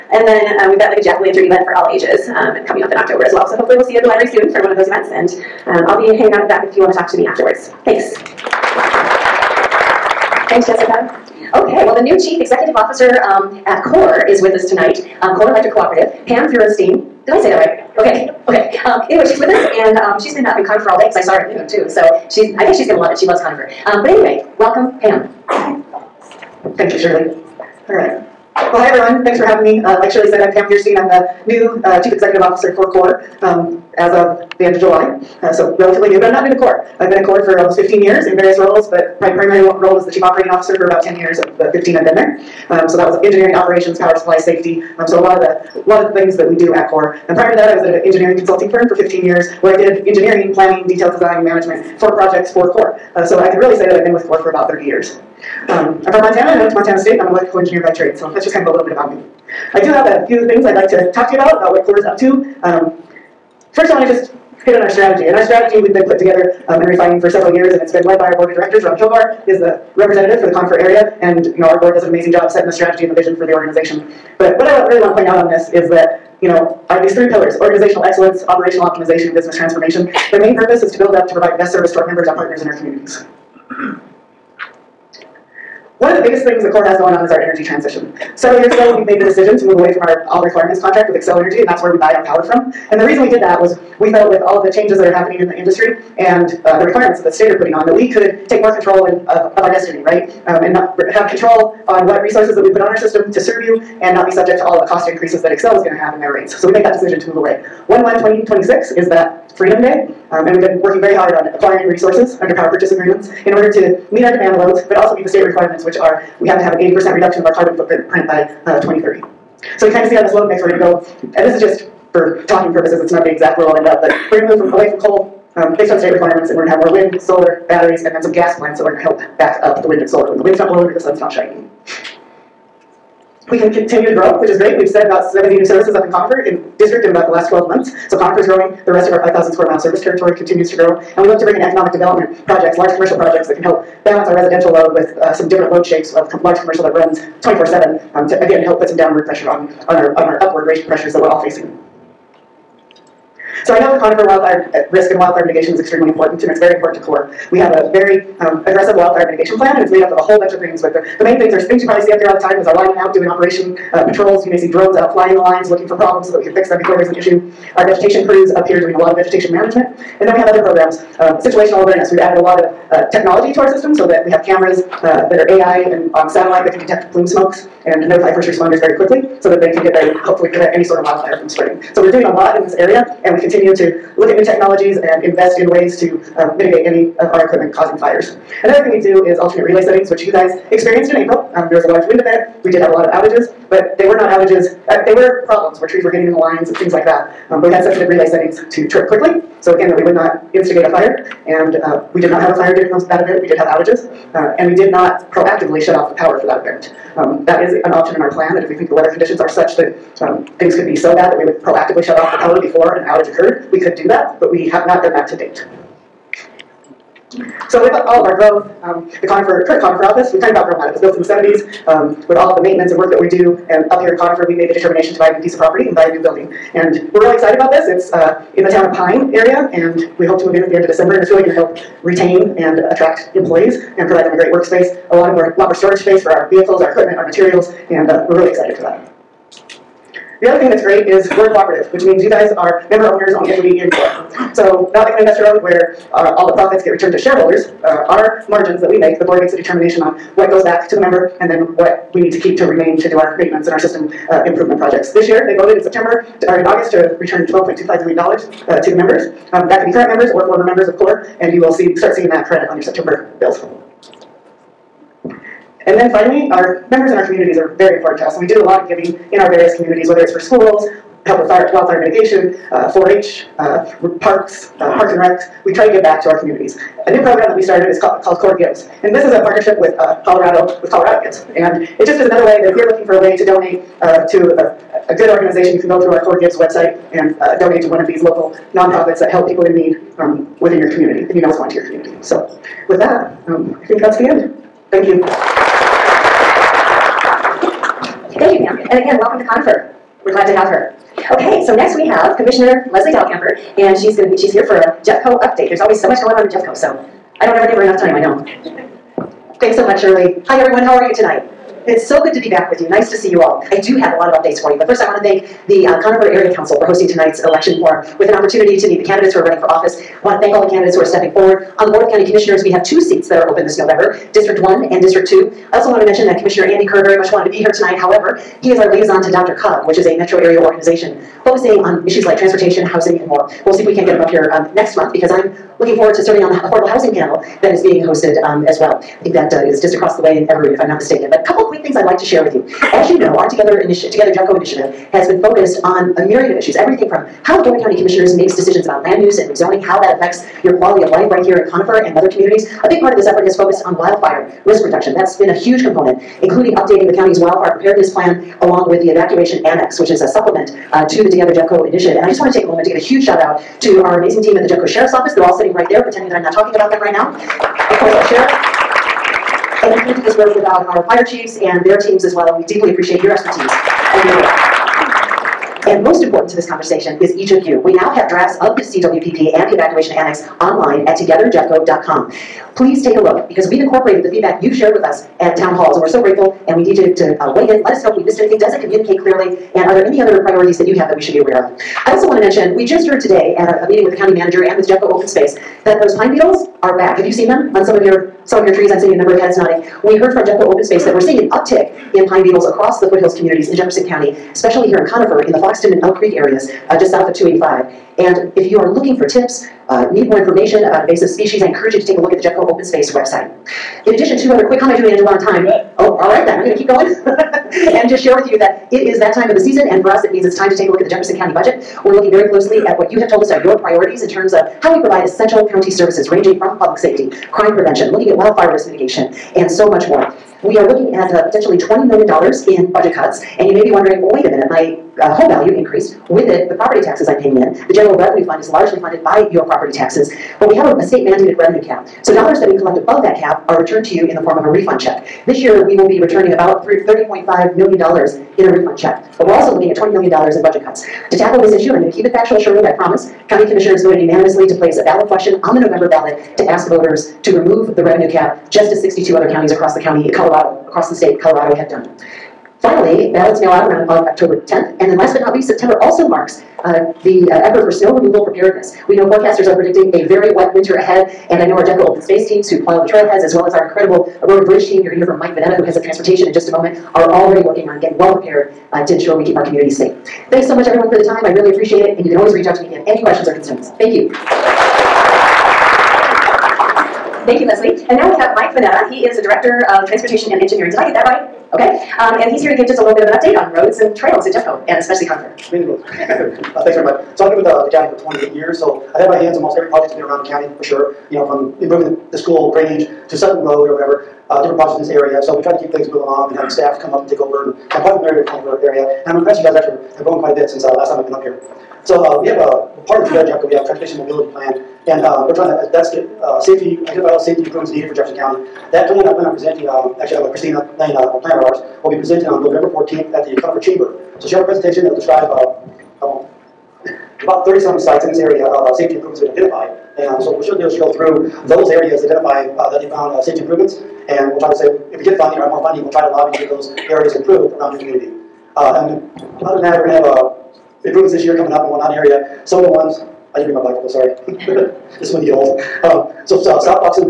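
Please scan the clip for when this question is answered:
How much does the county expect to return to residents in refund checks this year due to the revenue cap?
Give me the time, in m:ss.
7:26.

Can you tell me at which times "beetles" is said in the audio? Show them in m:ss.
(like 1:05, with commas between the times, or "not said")
6:36, 6:42.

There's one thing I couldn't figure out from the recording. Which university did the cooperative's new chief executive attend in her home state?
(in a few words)
Montana State.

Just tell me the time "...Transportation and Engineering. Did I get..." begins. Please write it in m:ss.
8:10.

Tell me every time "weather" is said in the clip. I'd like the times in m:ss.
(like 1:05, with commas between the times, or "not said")
3:28.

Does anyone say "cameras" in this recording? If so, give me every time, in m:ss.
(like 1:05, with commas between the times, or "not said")
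2:54.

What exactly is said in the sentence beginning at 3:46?
And we're really excited about this.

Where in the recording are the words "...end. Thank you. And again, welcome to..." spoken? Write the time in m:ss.
4:54.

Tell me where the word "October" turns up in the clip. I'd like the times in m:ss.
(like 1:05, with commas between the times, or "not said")
0:02, 7:44.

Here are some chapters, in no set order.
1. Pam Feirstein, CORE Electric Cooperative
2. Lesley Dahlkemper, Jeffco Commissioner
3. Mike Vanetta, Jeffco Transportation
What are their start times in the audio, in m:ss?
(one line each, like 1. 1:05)
1. 0:09
2. 5:00
3. 8:05.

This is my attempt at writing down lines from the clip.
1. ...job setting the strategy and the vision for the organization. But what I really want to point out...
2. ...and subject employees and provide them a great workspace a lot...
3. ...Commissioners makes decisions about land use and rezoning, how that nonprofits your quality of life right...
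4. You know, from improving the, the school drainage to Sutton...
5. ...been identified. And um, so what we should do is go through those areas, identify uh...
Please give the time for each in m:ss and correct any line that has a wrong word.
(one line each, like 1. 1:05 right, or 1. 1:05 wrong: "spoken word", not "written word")
1. 1:12 right
2. 3:52 wrong: "attract", not "subject"
3. 5:47 wrong: "affects", not "nonprofits"
4. 8:21 right
5. 8:49 right.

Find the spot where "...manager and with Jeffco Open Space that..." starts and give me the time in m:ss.
6:34.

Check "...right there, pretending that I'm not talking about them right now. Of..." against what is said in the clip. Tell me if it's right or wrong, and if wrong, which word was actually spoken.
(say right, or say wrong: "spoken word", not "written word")
right.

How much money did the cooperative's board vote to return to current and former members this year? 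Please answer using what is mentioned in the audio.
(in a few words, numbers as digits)
$12.25 million.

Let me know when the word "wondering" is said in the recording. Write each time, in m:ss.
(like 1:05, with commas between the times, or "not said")
7:13.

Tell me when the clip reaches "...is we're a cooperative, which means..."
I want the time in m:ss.
4:01.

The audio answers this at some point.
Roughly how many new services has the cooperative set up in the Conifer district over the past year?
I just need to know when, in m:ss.
2:15.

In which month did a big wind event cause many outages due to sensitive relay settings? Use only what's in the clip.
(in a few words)
April.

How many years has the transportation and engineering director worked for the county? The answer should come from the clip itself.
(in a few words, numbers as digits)
28.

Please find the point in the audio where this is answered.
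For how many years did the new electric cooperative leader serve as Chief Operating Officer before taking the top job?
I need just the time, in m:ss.
0:40.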